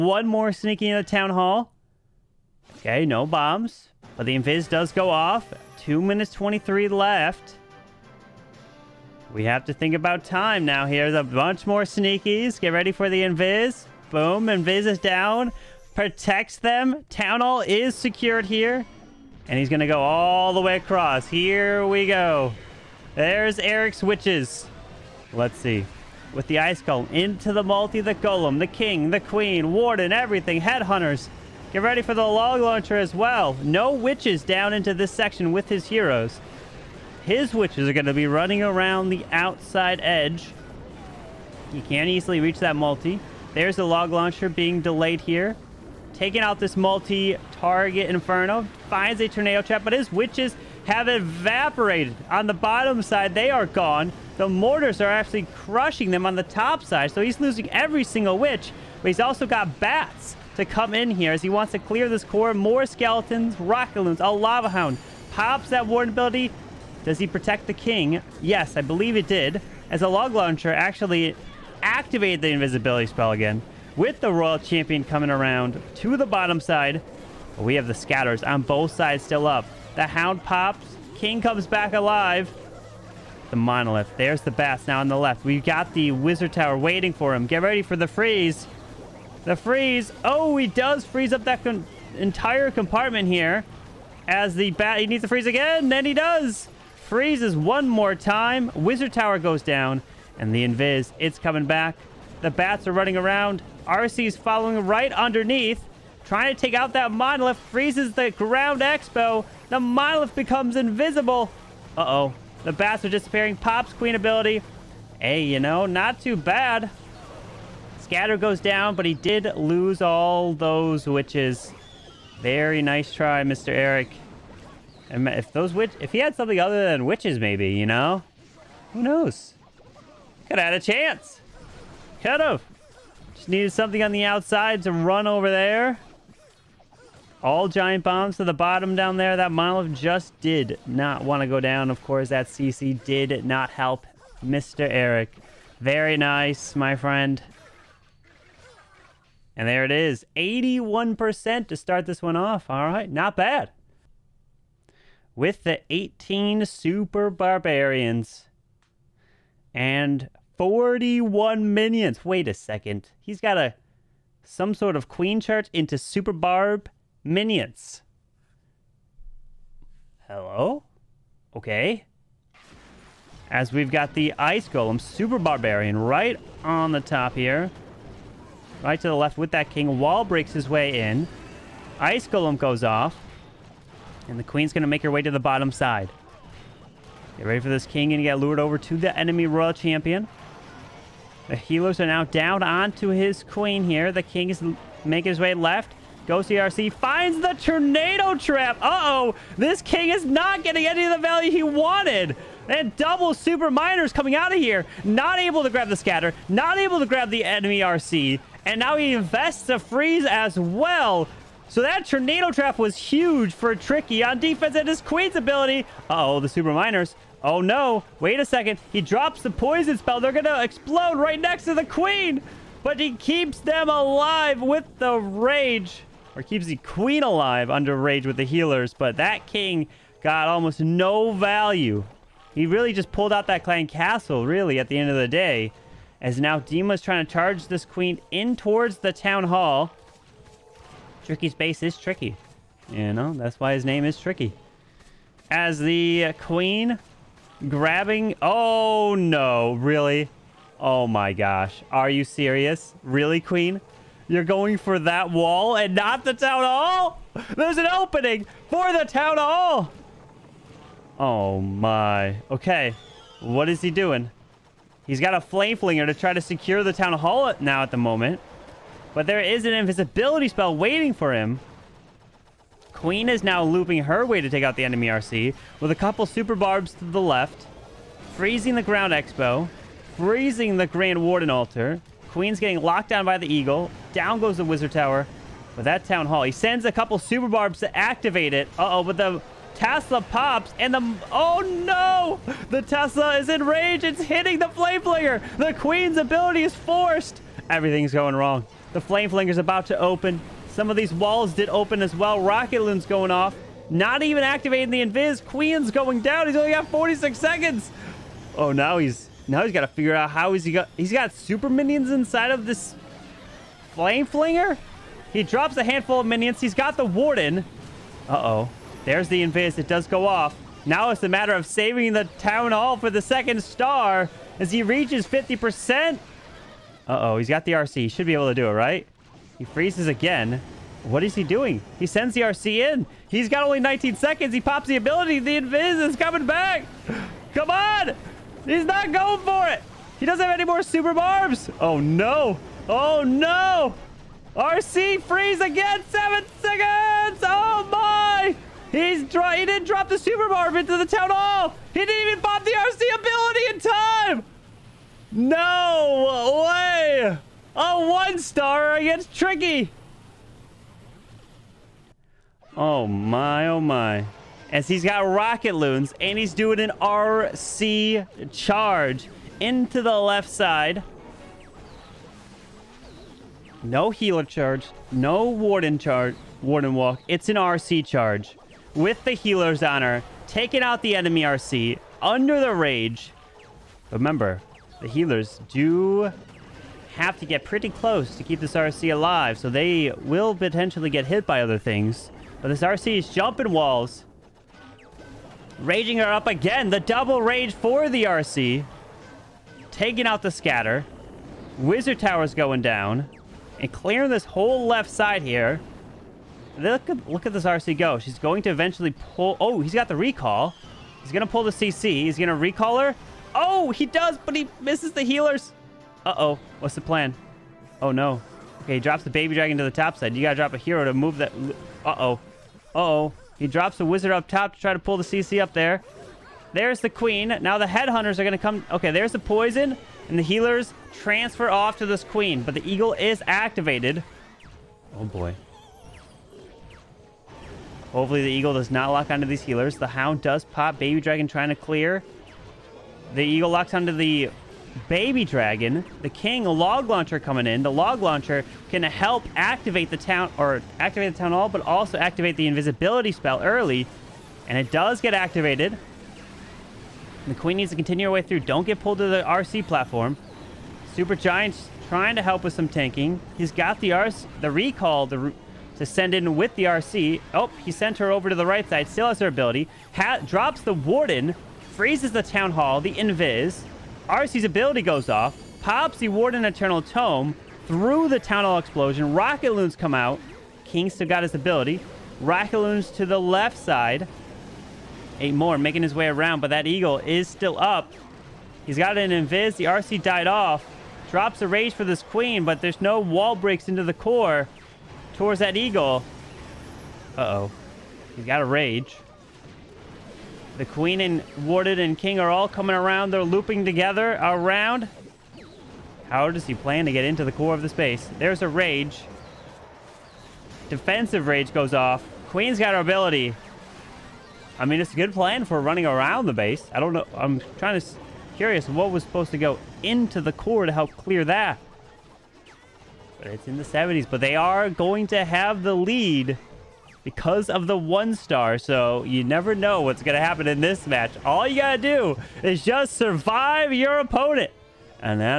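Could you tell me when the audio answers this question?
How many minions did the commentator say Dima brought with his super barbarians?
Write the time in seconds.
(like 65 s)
160 s.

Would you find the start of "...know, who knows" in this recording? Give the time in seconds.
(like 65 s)
127 s.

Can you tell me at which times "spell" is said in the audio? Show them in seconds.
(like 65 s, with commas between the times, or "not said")
73 s, 219 s, 270 s, 453 s.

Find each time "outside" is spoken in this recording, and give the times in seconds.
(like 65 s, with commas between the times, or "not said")
39 s, 134 s.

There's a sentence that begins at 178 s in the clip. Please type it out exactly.
Right to the left with that king.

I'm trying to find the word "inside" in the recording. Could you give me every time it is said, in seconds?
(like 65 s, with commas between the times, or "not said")
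312 s.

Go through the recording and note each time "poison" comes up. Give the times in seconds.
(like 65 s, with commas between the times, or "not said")
219 s, 429 s.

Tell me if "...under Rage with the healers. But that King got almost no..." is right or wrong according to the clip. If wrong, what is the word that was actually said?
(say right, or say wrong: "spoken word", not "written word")
right.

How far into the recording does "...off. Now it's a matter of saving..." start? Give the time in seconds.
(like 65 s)
320 s.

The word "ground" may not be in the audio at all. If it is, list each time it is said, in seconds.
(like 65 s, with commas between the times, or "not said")
108 s, 278 s.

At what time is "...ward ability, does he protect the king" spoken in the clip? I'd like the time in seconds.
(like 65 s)
65 s.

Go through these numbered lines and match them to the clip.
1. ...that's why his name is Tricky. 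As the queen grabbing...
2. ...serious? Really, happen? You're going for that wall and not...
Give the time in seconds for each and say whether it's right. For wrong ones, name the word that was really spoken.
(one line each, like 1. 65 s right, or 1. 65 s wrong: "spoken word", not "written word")
1. 243 s right
2. 252 s wrong: "queen", not "happen".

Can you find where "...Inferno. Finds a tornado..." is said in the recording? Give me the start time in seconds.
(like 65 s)
48 s.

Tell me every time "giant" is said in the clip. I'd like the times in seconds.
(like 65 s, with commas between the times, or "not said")
137 s, 461 s.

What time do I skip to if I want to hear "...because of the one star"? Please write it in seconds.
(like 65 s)
527 s.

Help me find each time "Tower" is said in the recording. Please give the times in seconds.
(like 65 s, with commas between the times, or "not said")
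86 s, 99 s, 284 s, 402 s.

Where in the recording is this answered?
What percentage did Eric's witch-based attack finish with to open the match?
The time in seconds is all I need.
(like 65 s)
150 s.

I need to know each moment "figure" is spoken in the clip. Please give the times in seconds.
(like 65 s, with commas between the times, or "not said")
309 s.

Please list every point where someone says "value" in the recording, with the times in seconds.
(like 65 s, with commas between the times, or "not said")
201 s, 231 s.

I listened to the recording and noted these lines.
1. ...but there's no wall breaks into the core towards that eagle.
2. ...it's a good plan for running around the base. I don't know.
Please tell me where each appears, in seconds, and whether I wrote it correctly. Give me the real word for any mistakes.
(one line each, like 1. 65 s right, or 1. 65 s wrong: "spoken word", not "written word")
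1. 492 s right
2. 514 s right.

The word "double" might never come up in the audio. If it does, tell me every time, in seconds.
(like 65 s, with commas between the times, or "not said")
202 s, 396 s.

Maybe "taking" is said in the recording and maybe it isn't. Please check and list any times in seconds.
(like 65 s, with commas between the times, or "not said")
46 s, 380 s, 399 s.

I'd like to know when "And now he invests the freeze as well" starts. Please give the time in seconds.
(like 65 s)
208 s.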